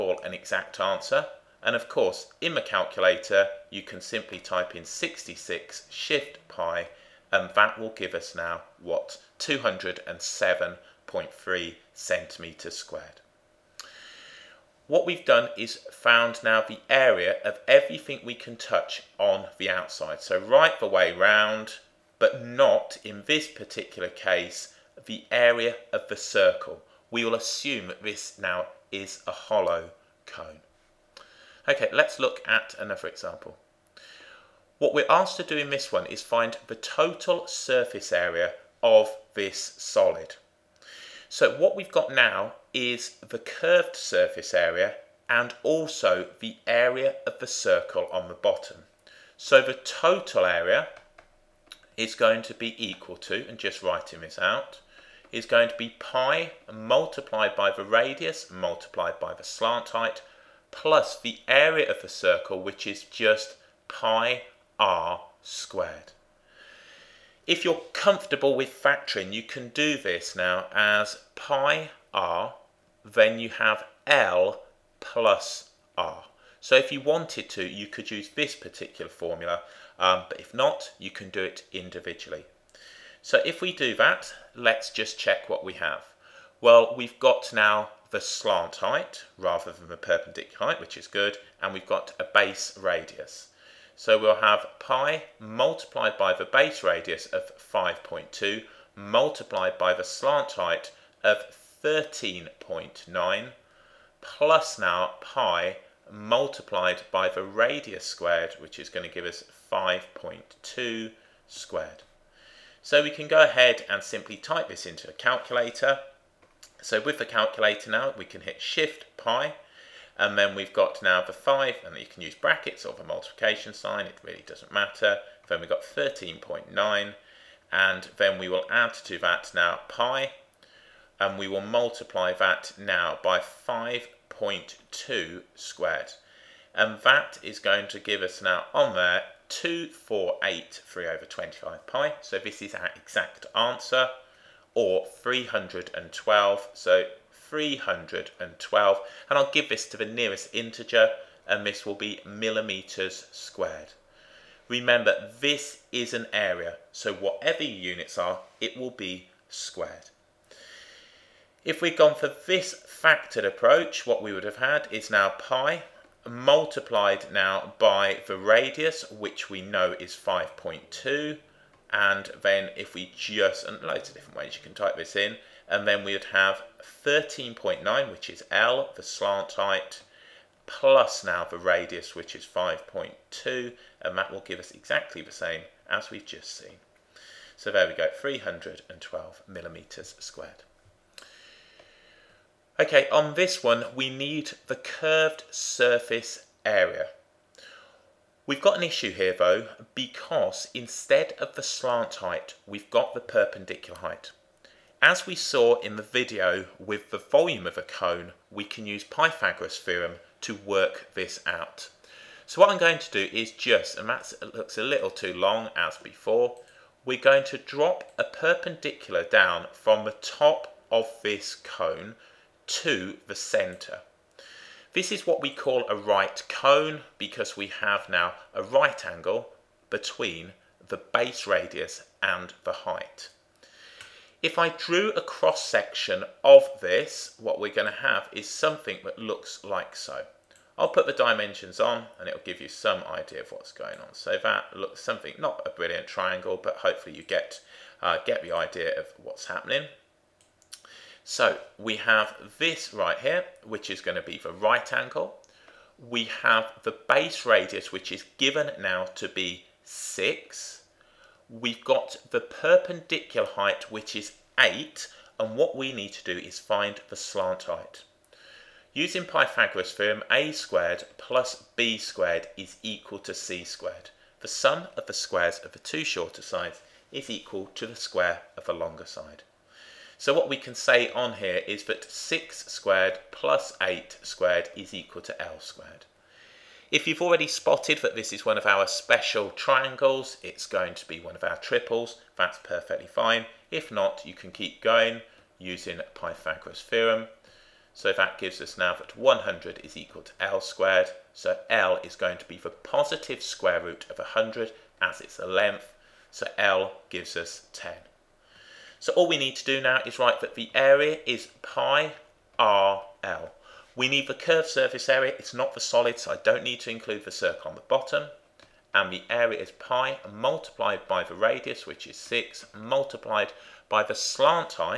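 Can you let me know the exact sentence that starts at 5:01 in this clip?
So L is going to be the positive square root of 100 as it's a length.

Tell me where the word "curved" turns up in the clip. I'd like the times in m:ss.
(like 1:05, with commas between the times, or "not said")
0:43, 3:14, 5:14.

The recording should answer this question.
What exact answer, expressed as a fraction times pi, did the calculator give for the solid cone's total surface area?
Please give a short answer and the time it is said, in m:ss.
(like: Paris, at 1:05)
2483 over 25 pi, at 2:19.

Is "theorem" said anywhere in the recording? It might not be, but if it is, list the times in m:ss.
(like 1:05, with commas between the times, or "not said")
3:29, 4:29, 4:56.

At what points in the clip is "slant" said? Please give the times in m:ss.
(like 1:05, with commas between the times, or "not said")
0:59, 1:28, 1:40, 2:59, 3:21, 4:27, 5:24.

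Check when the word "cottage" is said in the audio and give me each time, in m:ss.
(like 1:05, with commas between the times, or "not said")
not said.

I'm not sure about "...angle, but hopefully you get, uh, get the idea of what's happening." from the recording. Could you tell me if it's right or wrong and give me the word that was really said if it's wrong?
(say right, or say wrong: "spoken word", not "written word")
wrong: "triangle", not "angle".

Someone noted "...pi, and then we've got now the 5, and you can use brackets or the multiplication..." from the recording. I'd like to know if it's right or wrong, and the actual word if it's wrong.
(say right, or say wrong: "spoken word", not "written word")
right.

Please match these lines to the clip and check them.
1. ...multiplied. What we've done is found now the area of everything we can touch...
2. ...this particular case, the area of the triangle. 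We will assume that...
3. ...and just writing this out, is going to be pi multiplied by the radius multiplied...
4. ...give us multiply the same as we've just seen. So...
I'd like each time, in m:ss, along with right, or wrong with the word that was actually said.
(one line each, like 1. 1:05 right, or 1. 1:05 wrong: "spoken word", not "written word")
1. 0:12 wrong: "squared", not "multiplied"
2. 0:23 wrong: "circle", not "triangle"
3. 0:53 right
4. 3:04 wrong: "exactly", not "multiply".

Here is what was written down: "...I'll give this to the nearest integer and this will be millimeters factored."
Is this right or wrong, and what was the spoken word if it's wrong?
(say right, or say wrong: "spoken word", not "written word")
wrong: "squared", not "factored".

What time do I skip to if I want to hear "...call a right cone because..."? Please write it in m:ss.
3:45.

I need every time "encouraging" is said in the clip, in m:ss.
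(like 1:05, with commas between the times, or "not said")
not said.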